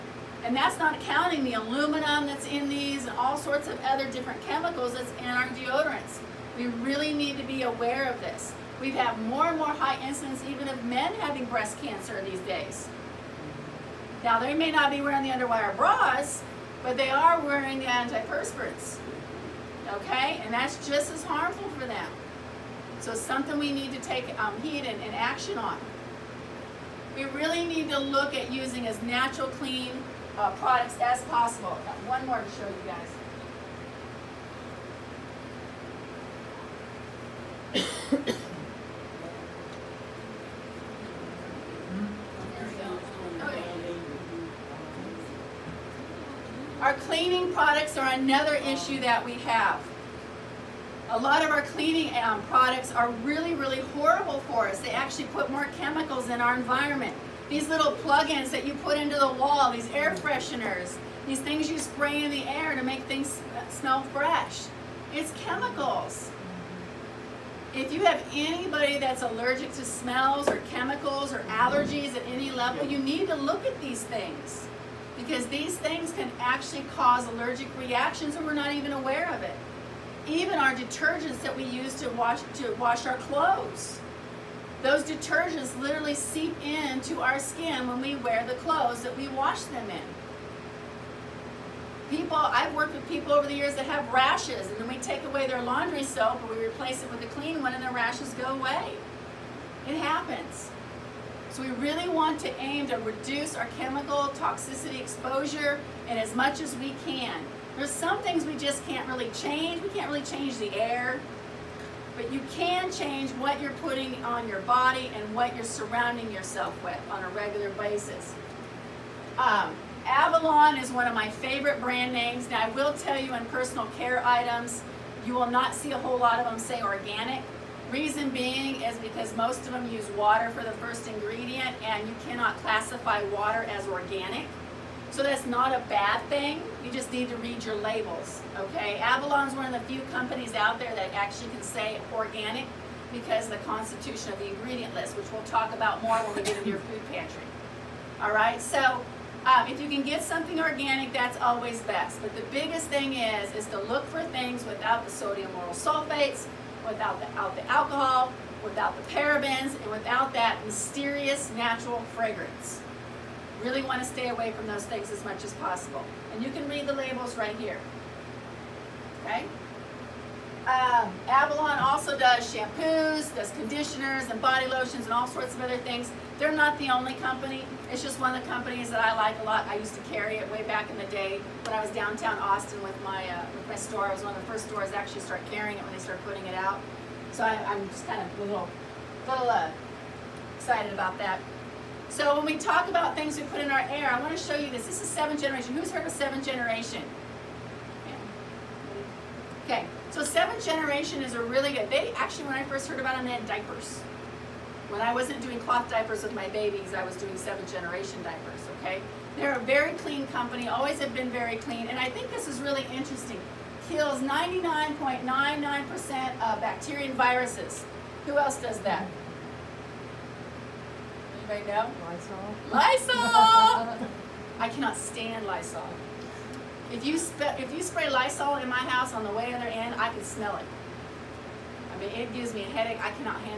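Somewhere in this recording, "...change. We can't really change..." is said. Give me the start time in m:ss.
1:49.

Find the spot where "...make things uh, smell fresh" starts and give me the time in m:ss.
1:02.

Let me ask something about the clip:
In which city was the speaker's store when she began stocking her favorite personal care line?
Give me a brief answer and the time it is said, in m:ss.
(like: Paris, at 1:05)
Austin, at 3:02.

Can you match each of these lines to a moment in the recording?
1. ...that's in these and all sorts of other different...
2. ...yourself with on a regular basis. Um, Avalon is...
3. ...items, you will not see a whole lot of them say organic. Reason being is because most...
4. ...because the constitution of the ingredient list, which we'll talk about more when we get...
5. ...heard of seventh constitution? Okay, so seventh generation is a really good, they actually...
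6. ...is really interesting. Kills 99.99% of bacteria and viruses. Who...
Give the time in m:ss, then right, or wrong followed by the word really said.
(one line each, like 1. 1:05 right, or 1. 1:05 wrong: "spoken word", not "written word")
1. 0:02 right
2. 1:56 right
3. 2:04 right
4. 2:23 right
5. 3:15 wrong: "generation", not "constitution"
6. 3:32 right.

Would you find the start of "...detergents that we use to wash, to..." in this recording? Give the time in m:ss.
1:20.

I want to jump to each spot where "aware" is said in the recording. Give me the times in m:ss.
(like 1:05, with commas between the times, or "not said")
0:07, 1:18.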